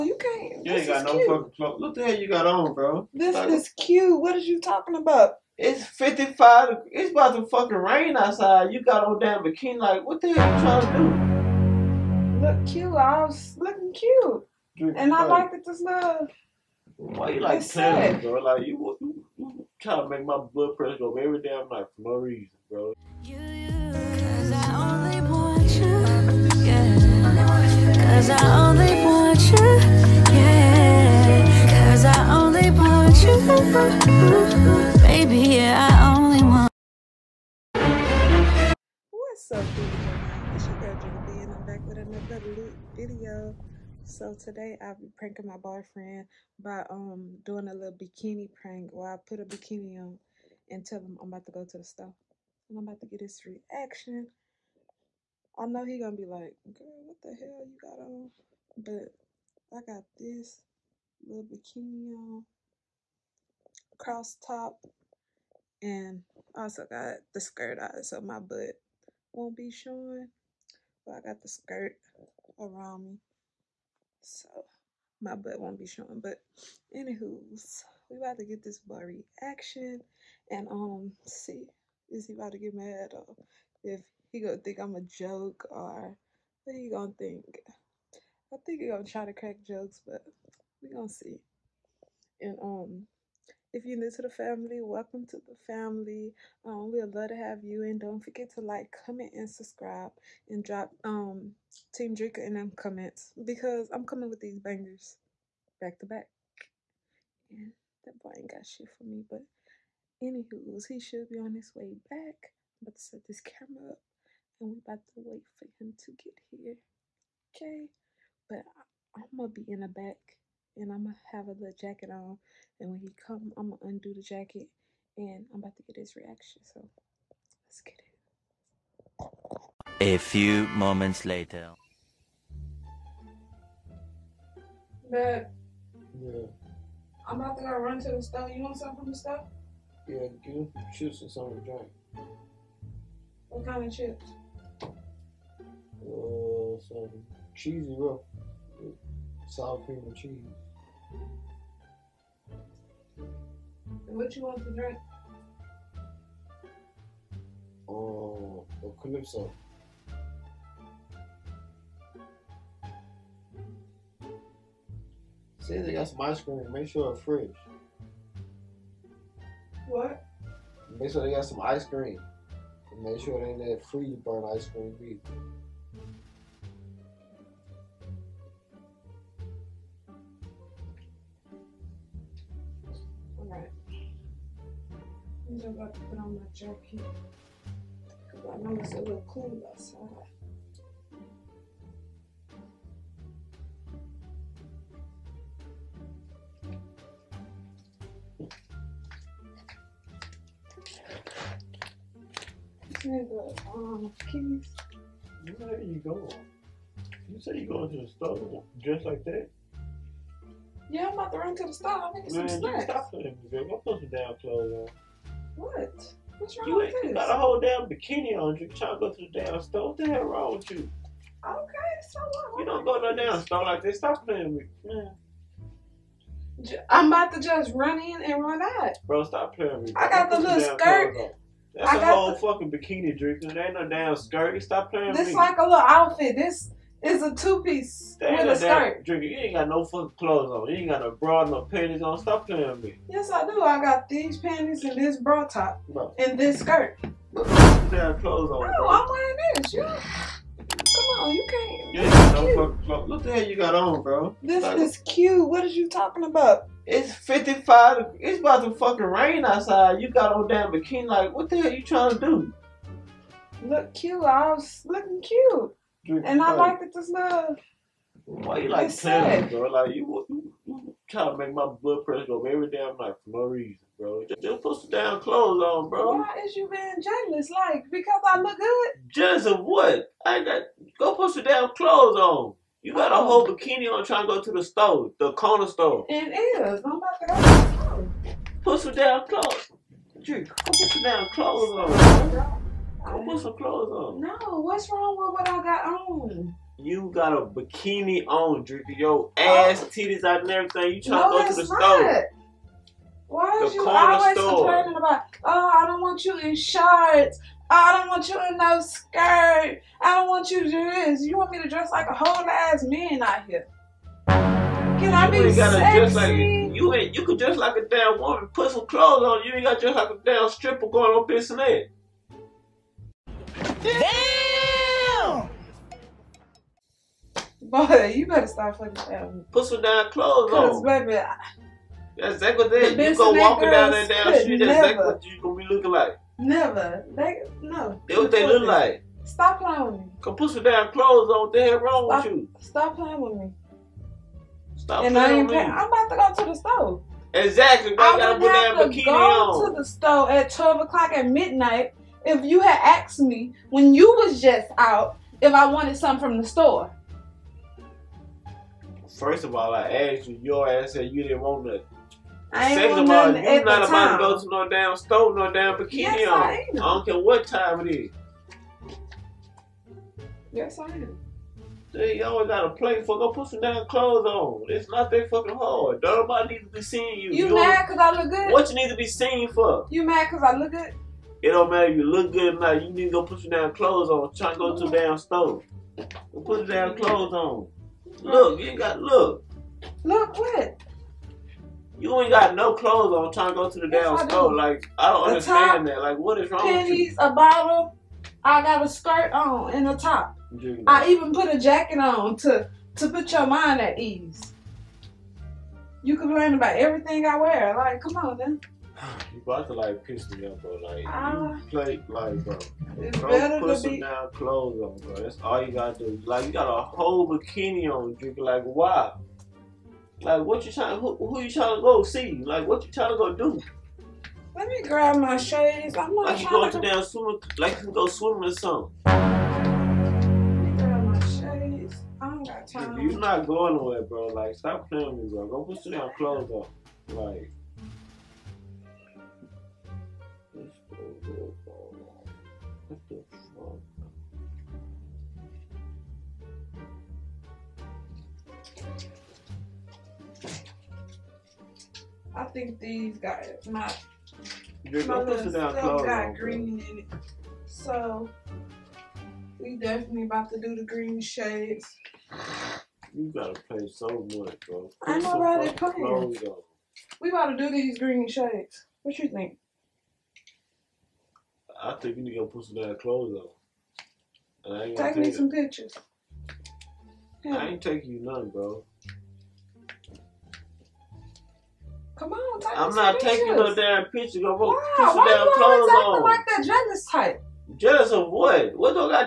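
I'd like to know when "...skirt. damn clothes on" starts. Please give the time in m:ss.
4:06.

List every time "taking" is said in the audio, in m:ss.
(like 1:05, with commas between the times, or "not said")
7:57, 8:03.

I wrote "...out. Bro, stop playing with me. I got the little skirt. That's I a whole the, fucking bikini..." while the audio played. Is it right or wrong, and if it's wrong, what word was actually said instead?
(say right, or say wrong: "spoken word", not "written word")
right.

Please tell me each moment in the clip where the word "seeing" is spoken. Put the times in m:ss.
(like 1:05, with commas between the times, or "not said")
6:16.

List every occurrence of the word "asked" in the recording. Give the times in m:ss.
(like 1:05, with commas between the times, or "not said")
5:52, 5:59.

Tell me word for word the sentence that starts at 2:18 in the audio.
You want something from the store?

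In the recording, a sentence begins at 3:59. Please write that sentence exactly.
Drika, you ain't got no fucking clothes on.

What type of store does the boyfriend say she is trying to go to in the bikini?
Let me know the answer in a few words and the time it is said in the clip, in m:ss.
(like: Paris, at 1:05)
Corner store, at 4:45.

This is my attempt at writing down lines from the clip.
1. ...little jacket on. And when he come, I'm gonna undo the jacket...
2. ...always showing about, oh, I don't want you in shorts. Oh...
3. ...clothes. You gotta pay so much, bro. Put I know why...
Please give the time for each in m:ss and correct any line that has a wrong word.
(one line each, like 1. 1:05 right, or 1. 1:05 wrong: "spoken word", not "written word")
1. 2:01 right
2. 5:03 wrong: "complaining", not "showing"
3. 7:41 wrong: "shades", not "clothes".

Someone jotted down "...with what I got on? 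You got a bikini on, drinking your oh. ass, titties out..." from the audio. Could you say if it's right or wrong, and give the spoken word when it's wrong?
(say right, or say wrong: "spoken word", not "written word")
right.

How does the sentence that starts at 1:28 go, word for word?
I think he gonna try to crack jokes, but we gonna see.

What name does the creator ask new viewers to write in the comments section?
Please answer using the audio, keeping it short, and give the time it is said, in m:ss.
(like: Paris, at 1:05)
Team Drika, at 1:41.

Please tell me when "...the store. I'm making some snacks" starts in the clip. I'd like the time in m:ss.
3:31.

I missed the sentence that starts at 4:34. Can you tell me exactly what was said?
Just, just put some damn clothes on, bro.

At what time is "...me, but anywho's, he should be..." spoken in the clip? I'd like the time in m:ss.
1:49.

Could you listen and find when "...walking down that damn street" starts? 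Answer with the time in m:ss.
5:33.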